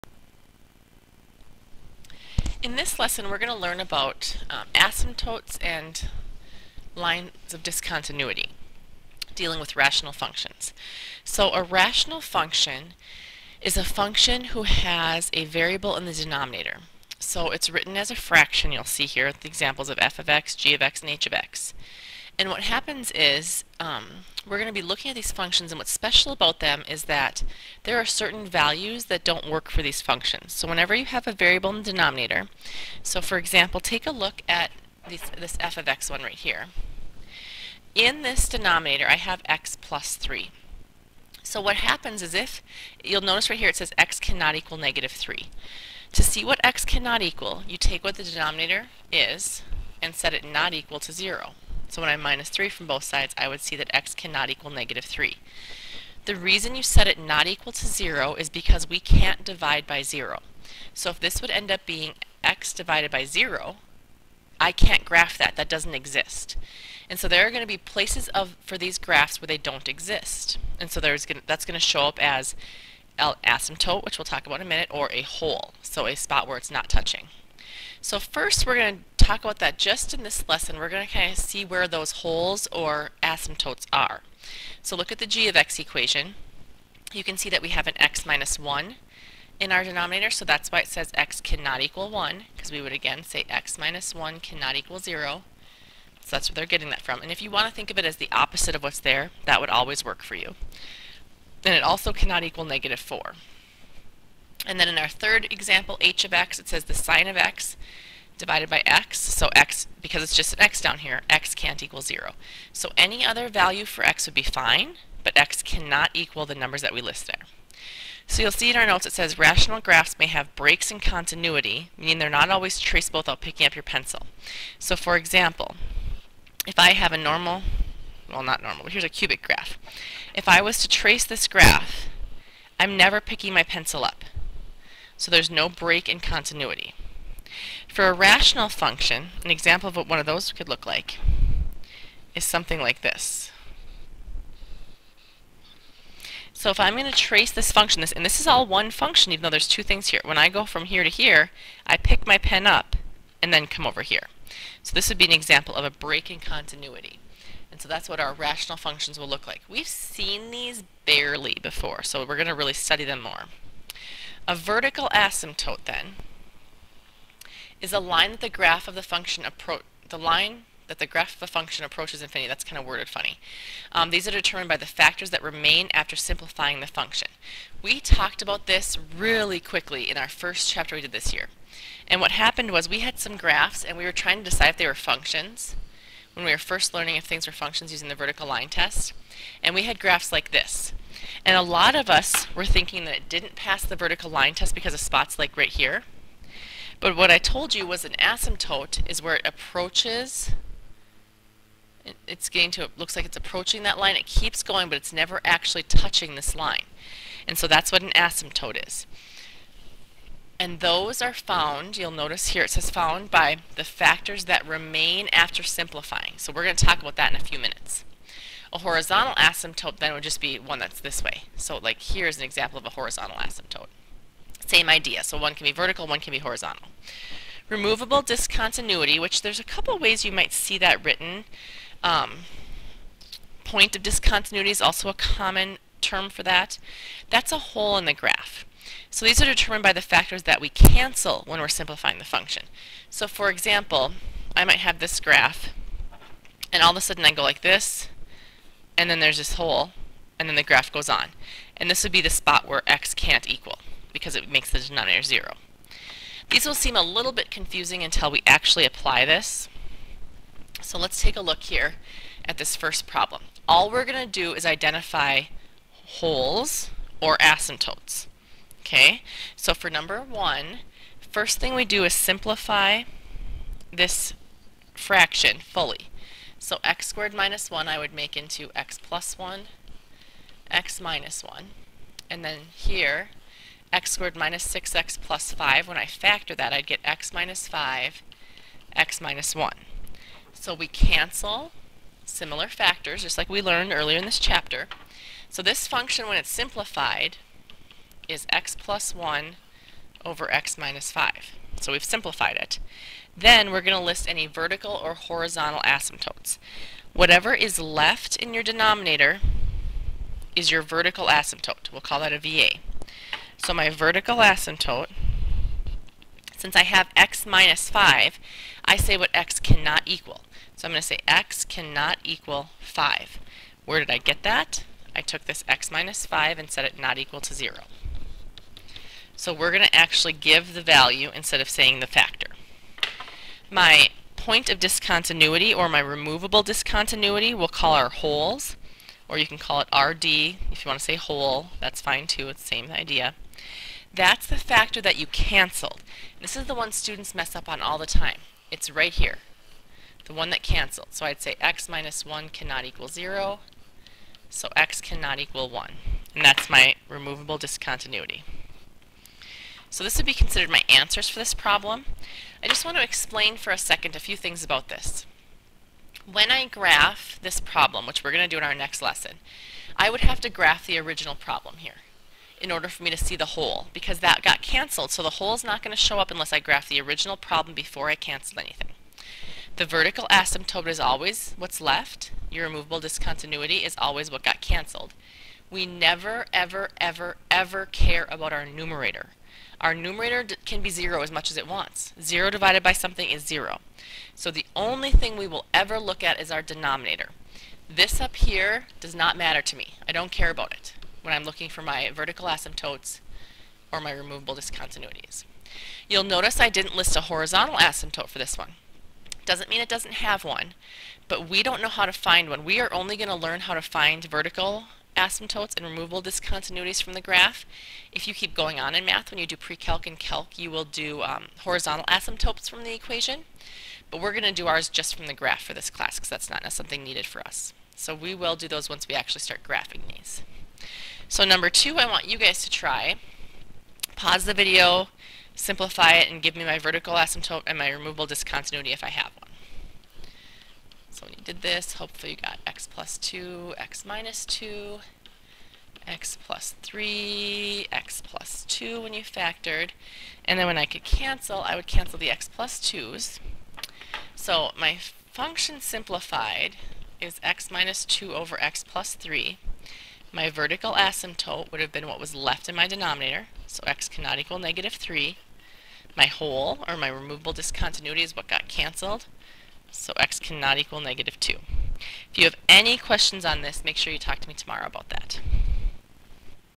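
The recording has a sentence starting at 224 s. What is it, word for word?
Same idea, so one can be vertical, one can be horizontal.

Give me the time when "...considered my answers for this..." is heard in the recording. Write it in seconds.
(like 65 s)
360 s.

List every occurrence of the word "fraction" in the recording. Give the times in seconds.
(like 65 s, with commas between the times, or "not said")
18 s, 274 s.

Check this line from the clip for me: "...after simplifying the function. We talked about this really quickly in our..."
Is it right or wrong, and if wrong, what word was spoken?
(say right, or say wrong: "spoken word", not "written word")
right.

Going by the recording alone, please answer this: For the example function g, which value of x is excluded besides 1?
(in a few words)
-4.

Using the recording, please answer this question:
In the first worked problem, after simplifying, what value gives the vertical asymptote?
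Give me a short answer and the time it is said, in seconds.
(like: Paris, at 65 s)
5, at 321 s.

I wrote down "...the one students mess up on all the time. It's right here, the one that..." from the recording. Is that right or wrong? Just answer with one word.
right.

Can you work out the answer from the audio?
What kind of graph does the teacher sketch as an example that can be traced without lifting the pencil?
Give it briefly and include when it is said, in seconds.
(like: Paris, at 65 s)
cubic graph, at 129 s.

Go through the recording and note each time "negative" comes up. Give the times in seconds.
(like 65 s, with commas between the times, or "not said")
44 s, 54 s, 102 s, 464 s, 471 s.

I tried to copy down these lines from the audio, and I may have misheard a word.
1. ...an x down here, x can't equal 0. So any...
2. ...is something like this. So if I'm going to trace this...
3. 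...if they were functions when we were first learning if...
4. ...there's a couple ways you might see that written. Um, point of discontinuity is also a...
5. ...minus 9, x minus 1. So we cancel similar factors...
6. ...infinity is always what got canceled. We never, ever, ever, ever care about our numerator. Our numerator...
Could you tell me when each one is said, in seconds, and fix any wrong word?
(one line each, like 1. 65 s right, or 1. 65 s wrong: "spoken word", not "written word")
1. 110 s right
2. 142 s right
3. 184 s right
4. 229 s right
5. 287 s wrong: "5", not "9"
6. 382 s wrong: "discontinuity", not "infinity".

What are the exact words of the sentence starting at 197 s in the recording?
But what I told you was an asymptote is where it approaches.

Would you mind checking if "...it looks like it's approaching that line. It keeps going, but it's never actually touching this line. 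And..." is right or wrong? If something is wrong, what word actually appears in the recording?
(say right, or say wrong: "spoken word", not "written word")
right.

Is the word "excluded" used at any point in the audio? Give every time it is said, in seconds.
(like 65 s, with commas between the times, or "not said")
not said.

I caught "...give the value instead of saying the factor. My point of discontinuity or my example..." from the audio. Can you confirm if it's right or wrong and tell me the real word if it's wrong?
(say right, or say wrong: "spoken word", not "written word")
wrong: "removable", not "example".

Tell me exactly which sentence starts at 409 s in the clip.
Doesn't mean it doesn't have one, but we don't know how to find one.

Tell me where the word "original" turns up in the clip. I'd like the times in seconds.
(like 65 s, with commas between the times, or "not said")
370 s, 377 s.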